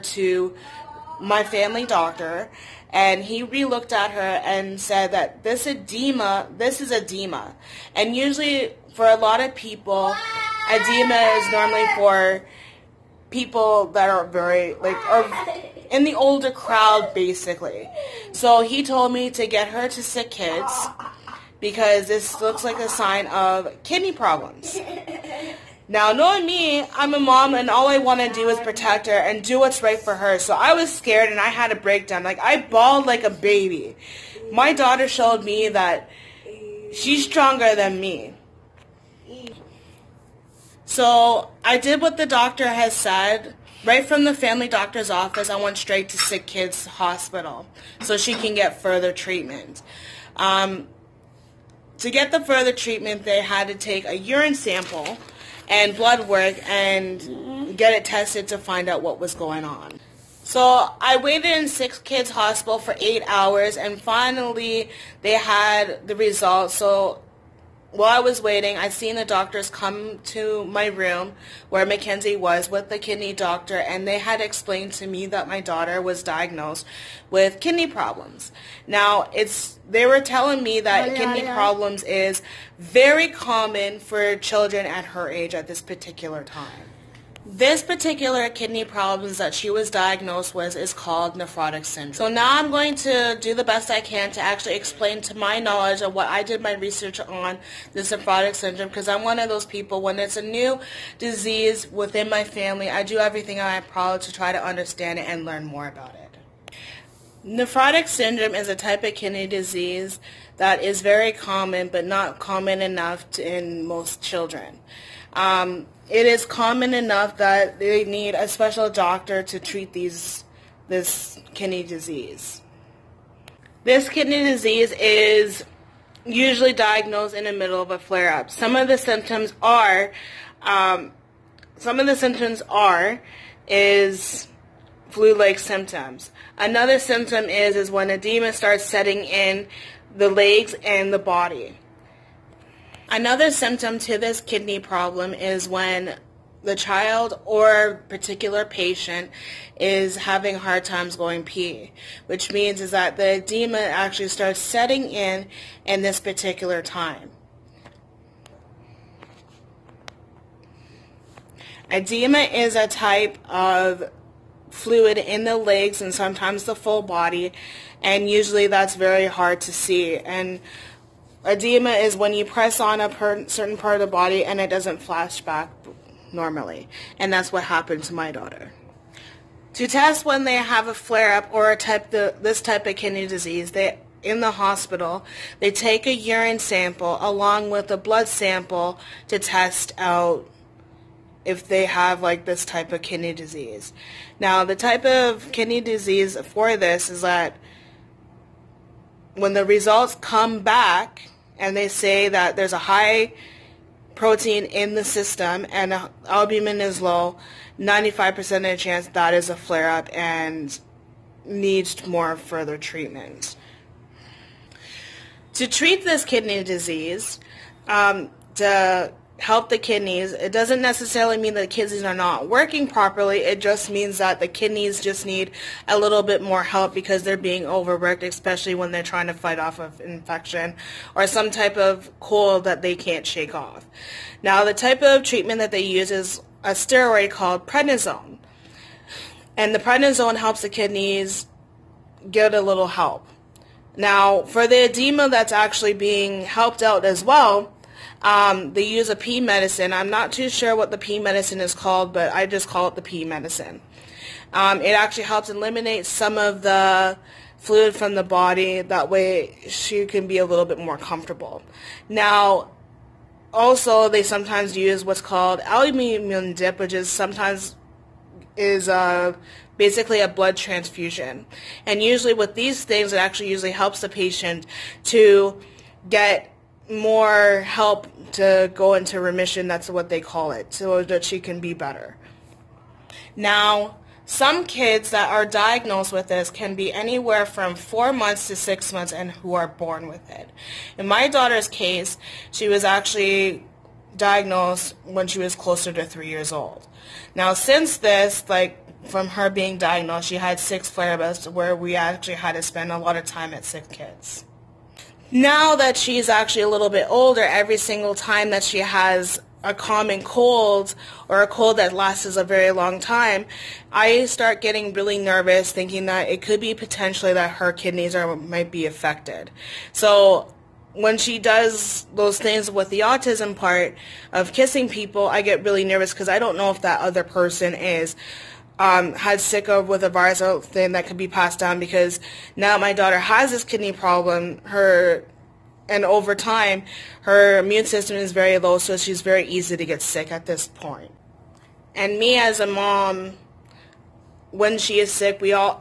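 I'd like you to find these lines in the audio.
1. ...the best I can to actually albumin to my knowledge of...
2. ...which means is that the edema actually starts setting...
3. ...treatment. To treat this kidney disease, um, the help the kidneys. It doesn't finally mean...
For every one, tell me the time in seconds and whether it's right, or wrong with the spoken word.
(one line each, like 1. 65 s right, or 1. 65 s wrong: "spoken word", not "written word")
1. 93 s wrong: "explain", not "albumin"
2. 152 s right
3. 212 s wrong: "necessarily", not "finally".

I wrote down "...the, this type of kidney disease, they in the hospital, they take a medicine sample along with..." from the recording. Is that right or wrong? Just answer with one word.
wrong.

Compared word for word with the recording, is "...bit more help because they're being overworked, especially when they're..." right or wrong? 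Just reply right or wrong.
right.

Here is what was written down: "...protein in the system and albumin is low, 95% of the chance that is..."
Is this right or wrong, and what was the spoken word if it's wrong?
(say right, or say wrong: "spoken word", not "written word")
right.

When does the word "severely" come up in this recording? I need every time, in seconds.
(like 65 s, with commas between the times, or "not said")
not said.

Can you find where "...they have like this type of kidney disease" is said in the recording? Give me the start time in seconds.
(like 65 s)
191 s.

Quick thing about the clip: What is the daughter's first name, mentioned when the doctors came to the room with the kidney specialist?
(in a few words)
Mackenzie.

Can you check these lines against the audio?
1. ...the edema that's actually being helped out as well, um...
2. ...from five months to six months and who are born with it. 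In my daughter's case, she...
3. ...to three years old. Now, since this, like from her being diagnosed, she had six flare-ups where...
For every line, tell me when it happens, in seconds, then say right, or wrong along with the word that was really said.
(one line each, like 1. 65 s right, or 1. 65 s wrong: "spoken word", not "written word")
1. 244 s right
2. 287 s wrong: "four", not "five"
3. 295 s right.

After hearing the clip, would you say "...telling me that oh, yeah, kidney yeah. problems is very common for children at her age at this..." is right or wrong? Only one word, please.
right.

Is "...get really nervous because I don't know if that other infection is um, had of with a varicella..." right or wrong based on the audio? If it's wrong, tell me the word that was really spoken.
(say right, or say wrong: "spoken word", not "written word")
wrong: "person", not "infection".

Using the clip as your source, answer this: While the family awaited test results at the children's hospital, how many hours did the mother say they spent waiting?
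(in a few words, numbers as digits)
8.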